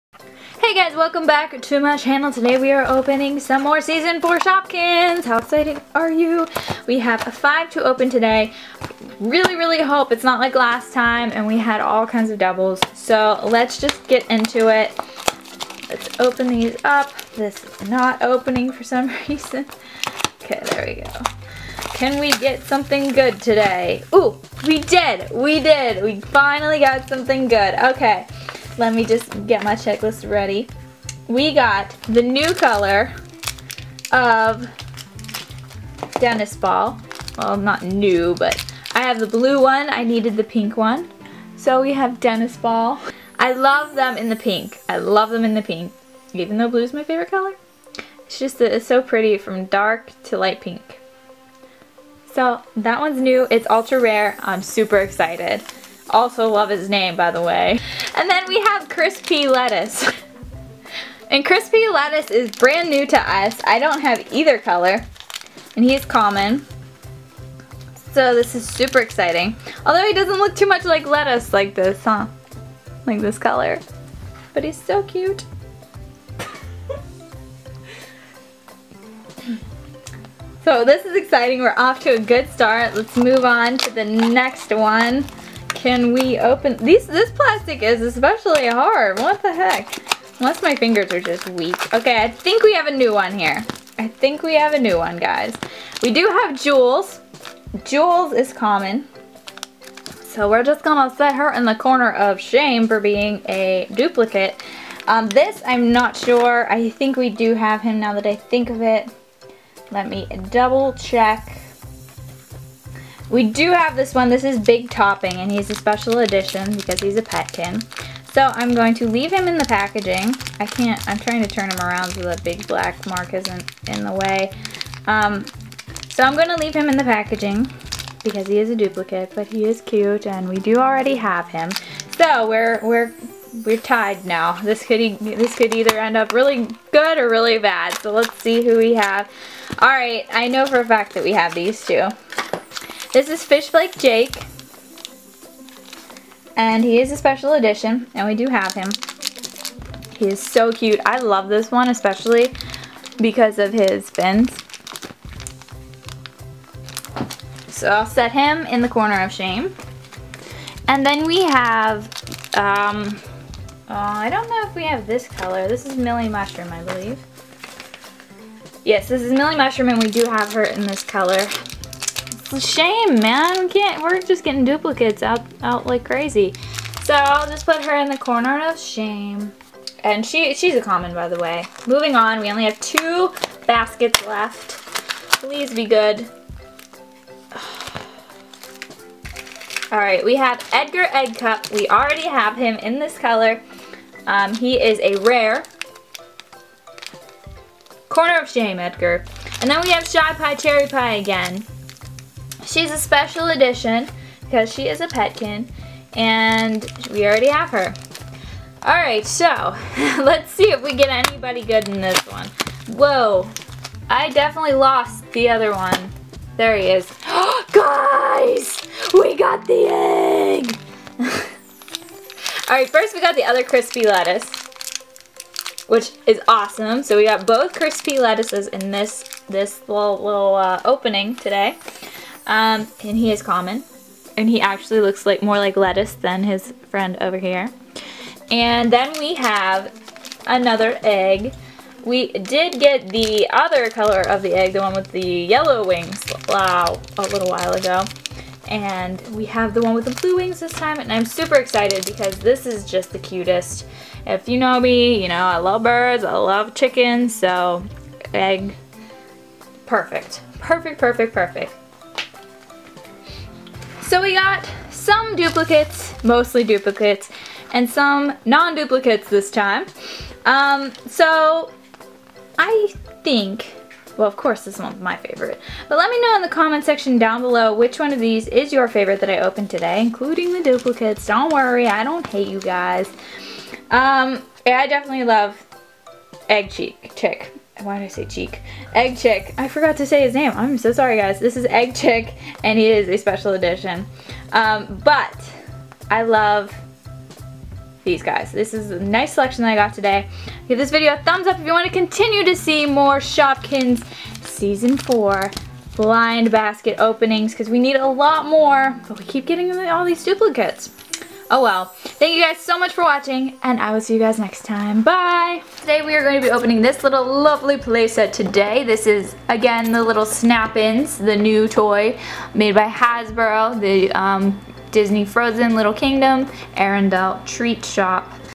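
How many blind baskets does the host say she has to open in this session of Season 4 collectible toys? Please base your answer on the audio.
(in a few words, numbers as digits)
5.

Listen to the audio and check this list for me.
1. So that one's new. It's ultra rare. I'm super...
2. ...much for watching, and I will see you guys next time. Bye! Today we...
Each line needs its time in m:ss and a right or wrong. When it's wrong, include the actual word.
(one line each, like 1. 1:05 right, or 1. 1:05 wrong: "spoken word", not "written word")
1. 0:52 right
2. 5:12 right.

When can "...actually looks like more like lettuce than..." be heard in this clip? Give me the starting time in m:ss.
3:54.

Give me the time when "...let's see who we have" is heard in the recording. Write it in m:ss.
2:18.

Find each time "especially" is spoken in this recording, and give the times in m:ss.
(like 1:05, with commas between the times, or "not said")
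1:28, 2:31.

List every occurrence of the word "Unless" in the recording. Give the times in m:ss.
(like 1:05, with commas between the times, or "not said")
1:30.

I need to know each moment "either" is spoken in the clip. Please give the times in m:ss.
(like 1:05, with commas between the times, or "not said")
1:04, 2:15.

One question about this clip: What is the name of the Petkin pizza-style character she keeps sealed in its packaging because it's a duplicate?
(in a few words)
Big Topping.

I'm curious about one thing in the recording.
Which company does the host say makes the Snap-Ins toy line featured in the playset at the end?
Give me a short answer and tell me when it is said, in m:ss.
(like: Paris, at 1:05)
Hasbro, at 5:22.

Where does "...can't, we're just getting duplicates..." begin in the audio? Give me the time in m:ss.
2:53.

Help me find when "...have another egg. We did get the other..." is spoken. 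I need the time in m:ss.
3:59.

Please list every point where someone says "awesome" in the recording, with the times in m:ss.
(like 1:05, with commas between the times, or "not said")
3:46.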